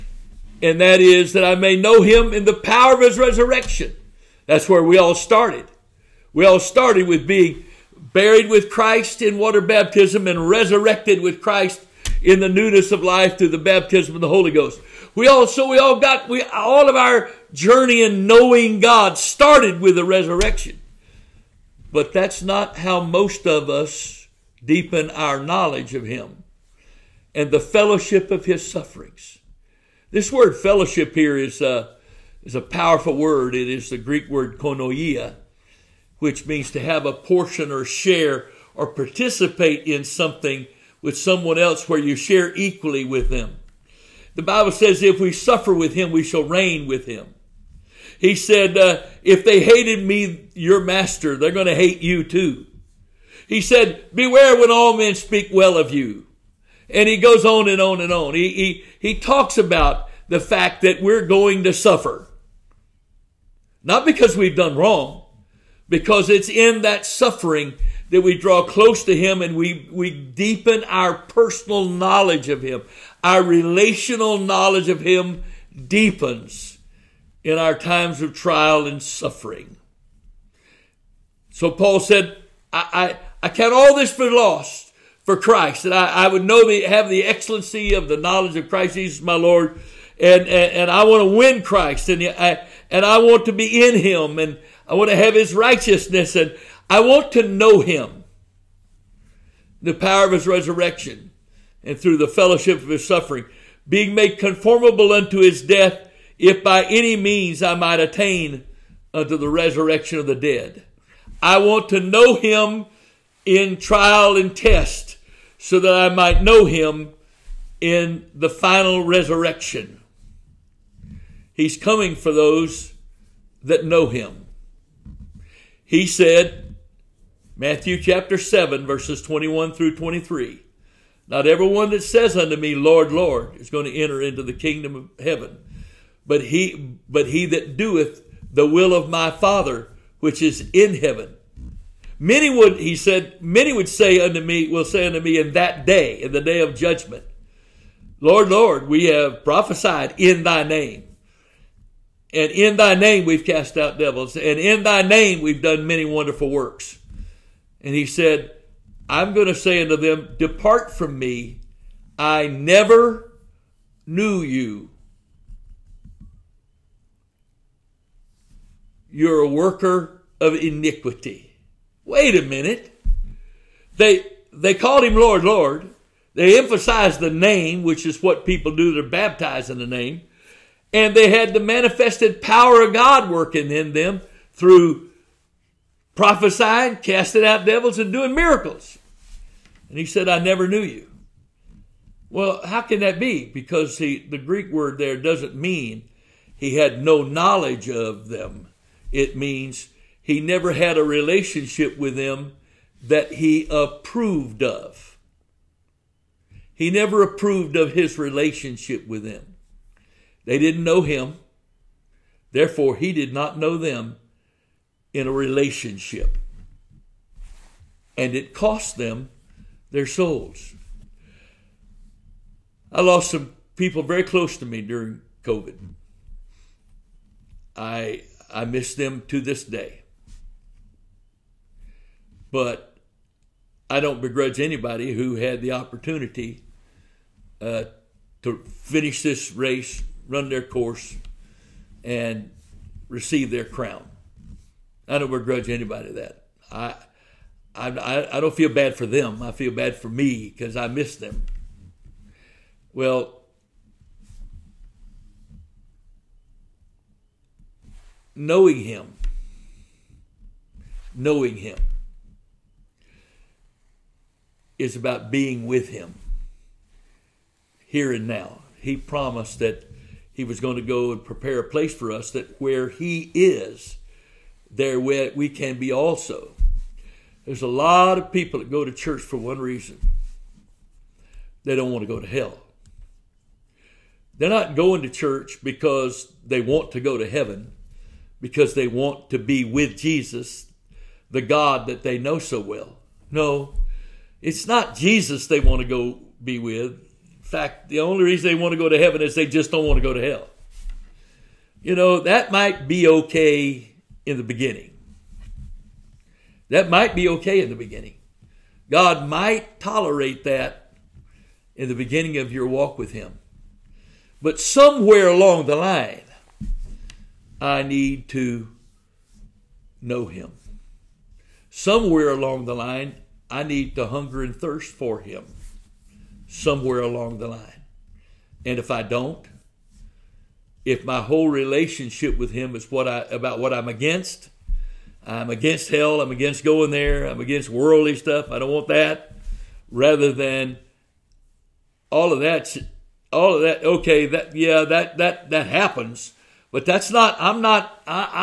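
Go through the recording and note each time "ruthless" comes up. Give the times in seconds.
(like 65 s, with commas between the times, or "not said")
not said.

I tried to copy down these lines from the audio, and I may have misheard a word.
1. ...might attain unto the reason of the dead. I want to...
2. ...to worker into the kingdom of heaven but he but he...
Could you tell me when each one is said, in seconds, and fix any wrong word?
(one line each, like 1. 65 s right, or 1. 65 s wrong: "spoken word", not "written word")
1. 107 s wrong: "resurrection", not "reason"
2. 133 s wrong: "enter", not "worker".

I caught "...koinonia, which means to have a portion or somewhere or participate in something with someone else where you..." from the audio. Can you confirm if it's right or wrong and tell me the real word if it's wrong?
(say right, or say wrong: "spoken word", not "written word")
wrong: "share", not "somewhere".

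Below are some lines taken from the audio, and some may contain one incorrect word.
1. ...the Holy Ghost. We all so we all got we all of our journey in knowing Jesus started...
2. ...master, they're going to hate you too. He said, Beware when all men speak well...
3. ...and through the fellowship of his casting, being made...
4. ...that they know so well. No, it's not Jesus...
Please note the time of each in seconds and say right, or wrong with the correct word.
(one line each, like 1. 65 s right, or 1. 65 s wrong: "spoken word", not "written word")
1. 14 s wrong: "God", not "Jesus"
2. 50 s right
3. 101 s wrong: "suffering", not "casting"
4. 291 s right.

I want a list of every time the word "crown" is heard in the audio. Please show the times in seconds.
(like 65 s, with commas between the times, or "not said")
243 s.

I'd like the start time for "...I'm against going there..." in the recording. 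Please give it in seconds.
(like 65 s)
336 s.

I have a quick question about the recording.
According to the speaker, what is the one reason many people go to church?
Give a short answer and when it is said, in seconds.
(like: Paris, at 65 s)
They don't want to go to hell, at 281 s.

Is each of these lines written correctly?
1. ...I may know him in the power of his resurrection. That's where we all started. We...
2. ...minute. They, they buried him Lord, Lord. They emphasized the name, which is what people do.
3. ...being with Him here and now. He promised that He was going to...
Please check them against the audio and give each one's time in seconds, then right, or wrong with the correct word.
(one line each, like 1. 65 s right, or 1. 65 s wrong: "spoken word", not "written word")
1. 1 s right
2. 172 s wrong: "called", not "buried"
3. 265 s right.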